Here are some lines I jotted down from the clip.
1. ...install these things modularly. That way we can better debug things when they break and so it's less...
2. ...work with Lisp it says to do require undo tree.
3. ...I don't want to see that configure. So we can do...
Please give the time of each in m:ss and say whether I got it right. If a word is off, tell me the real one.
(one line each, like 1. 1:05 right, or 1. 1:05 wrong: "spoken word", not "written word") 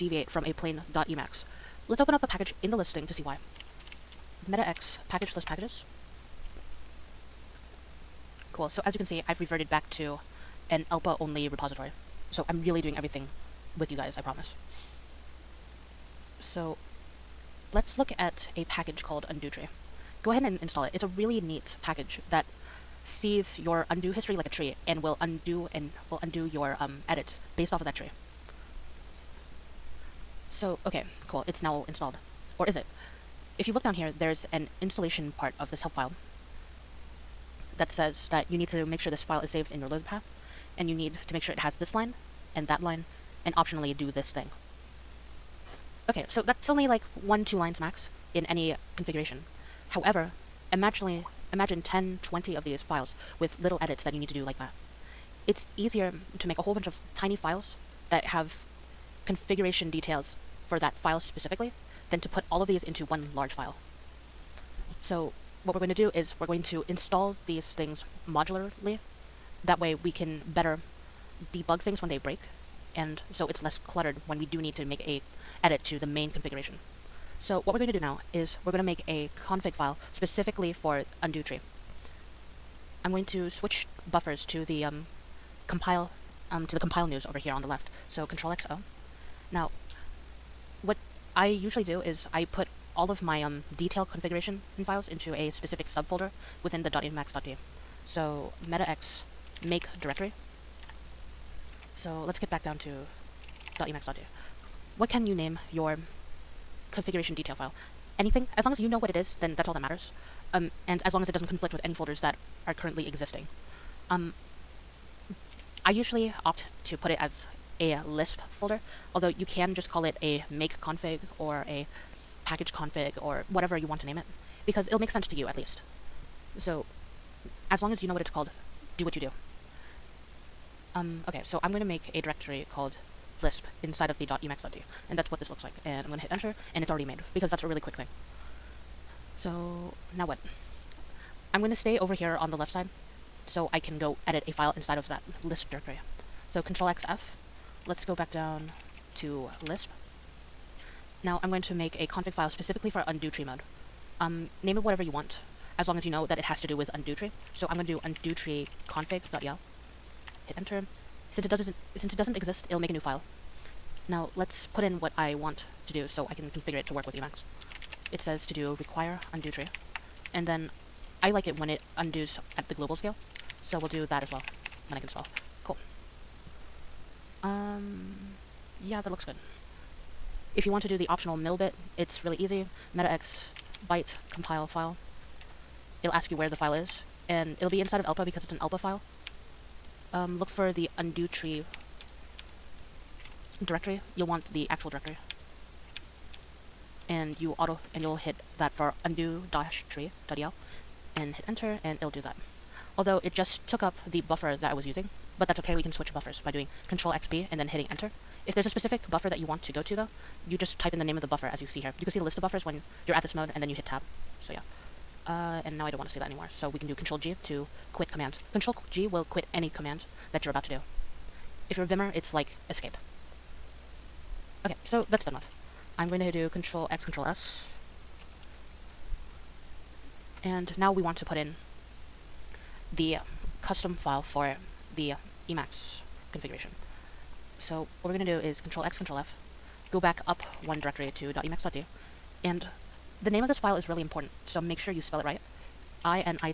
1. 1:06 right
2. 2:46 wrong: "Emacs", not "Lisp"
3. 3:35 wrong: "anymore", not "configure".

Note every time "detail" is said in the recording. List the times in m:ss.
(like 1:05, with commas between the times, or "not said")
0:59, 1:33, 1:47.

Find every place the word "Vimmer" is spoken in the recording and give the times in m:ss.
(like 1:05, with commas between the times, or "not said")
3:41.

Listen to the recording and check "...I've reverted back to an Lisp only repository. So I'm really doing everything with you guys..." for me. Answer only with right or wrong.
wrong.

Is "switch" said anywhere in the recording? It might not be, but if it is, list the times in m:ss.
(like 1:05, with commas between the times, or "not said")
1:23, 3:25.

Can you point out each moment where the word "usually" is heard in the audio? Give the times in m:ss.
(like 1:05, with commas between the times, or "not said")
1:31, 1:55.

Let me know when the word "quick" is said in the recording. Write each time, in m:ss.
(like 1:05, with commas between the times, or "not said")
2:17.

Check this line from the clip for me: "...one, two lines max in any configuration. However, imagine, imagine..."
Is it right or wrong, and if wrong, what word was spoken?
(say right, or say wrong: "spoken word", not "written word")
right.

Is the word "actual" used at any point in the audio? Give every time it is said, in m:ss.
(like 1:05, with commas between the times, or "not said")
3:14.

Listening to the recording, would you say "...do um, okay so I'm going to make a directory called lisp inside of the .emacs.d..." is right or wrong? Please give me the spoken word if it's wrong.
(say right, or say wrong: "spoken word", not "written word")
right.